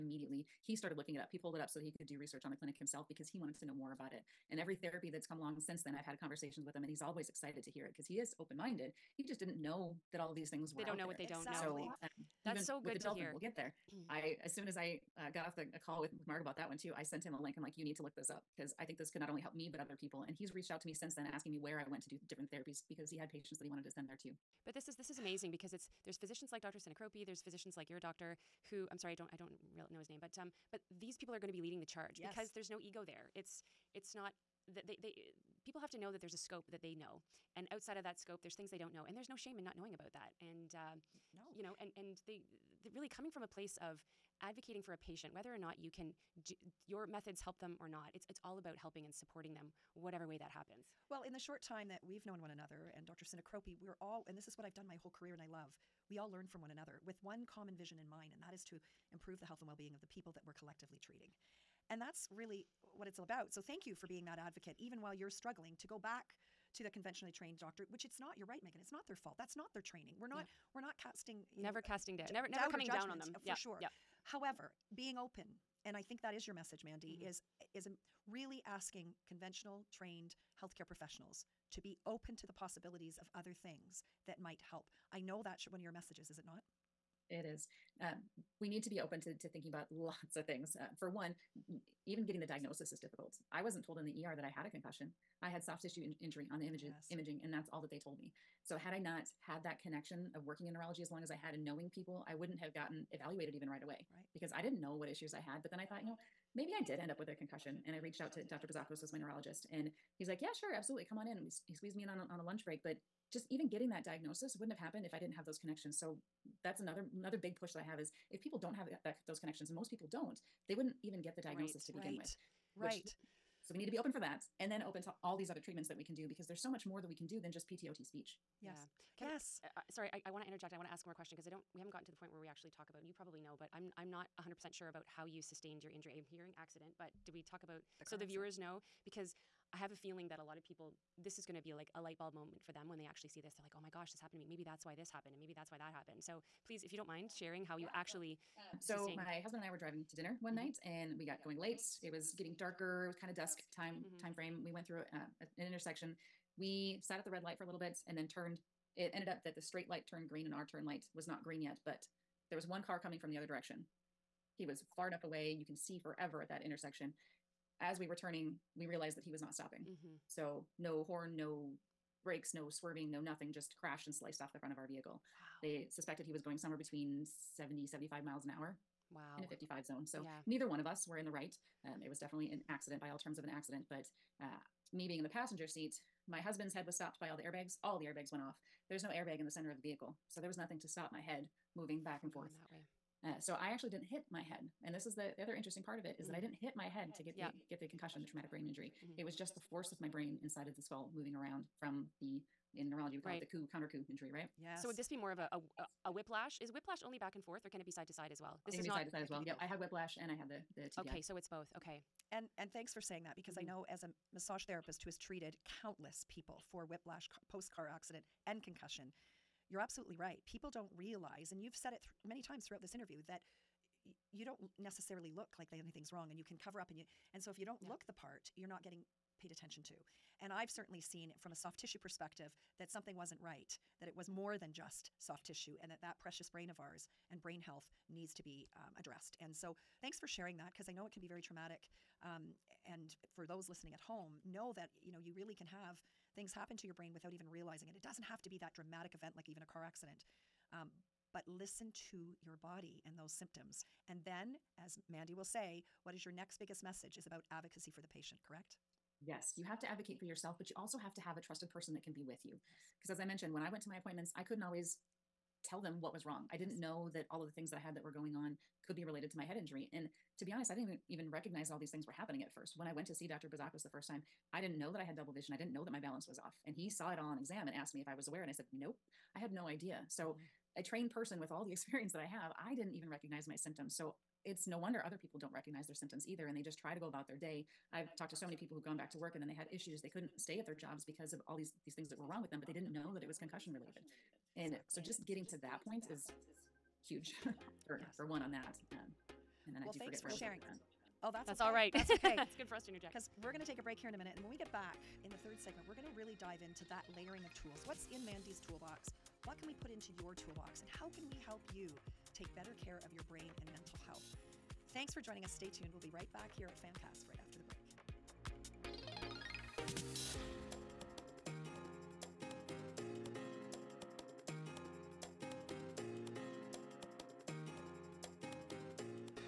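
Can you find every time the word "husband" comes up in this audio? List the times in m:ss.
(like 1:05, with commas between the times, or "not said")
2:29, 3:06.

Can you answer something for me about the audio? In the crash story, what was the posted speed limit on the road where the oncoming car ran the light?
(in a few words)
55.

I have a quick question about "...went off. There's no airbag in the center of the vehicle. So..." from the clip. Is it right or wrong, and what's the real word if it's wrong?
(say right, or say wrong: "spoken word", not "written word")
right.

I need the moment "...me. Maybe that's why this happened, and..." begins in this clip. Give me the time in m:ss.
2:24.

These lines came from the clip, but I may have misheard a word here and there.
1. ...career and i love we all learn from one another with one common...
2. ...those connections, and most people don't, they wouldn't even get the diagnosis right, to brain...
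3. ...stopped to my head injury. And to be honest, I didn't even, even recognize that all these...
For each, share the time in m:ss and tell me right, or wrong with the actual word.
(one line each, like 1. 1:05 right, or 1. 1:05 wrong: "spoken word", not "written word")
1. 0:55 right
2. 1:59 wrong: "begin", not "brain"
3. 4:29 wrong: "related", not "stopped".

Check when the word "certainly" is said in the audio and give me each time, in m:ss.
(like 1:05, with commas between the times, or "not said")
3:50.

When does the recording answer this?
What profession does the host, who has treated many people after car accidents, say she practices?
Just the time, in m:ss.
3:34.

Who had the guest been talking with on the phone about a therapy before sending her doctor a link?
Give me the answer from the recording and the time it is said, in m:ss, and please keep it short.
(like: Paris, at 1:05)
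Mark, at 0:16.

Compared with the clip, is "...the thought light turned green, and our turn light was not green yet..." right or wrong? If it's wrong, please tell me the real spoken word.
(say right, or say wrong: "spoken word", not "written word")
wrong: "straight", not "thought".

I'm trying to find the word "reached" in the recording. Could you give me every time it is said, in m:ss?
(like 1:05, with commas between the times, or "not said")
0:20, 1:47.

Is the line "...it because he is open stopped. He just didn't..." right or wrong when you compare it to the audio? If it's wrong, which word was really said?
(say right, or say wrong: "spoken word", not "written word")
wrong: "minded", not "stopped".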